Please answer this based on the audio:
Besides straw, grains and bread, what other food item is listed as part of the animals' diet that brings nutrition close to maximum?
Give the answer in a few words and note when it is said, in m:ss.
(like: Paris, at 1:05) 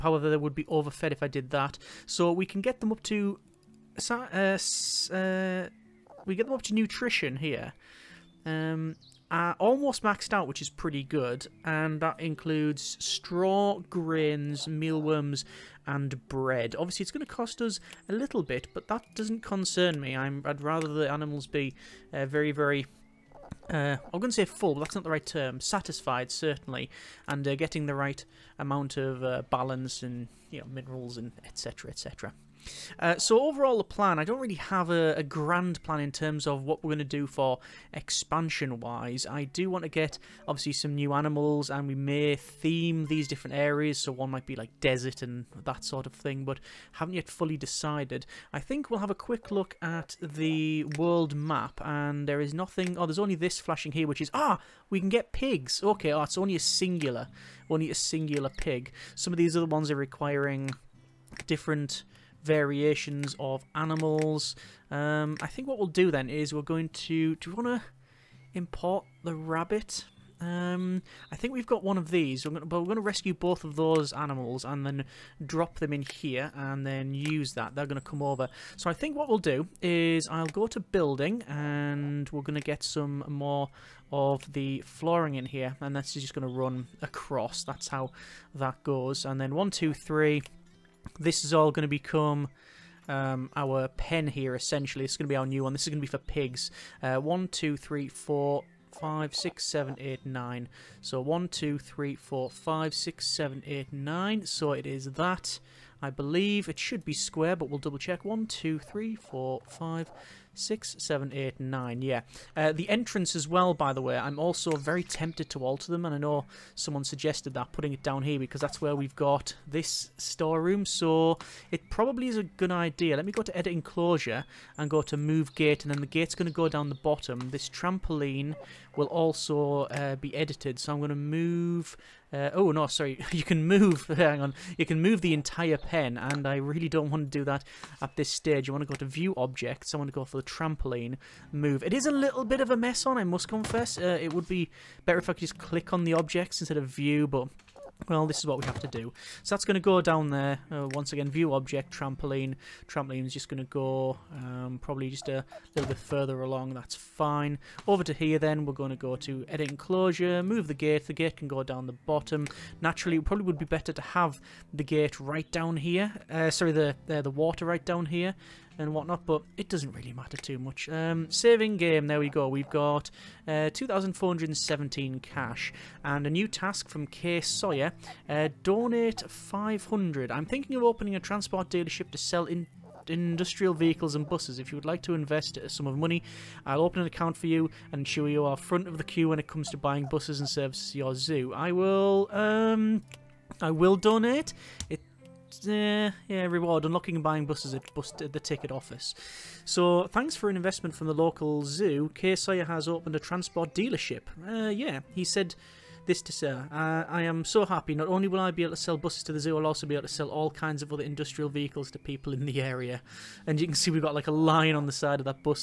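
mealworms, at 0:14.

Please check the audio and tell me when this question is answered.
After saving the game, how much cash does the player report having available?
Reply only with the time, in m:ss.
2:53.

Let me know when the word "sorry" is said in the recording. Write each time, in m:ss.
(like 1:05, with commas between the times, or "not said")
2:12, 2:46.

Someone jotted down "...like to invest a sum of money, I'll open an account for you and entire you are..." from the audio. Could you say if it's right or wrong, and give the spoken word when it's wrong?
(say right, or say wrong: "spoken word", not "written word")
wrong: "ensure", not "entire".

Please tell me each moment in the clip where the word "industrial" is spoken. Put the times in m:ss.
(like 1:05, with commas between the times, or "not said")
3:03, 3:31.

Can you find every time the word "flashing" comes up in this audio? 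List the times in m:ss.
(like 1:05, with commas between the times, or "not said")
0:53.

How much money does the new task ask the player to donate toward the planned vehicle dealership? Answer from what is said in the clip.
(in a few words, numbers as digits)
500.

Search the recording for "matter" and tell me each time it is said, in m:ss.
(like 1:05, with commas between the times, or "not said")
2:50.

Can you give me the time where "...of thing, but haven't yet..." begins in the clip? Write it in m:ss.
0:46.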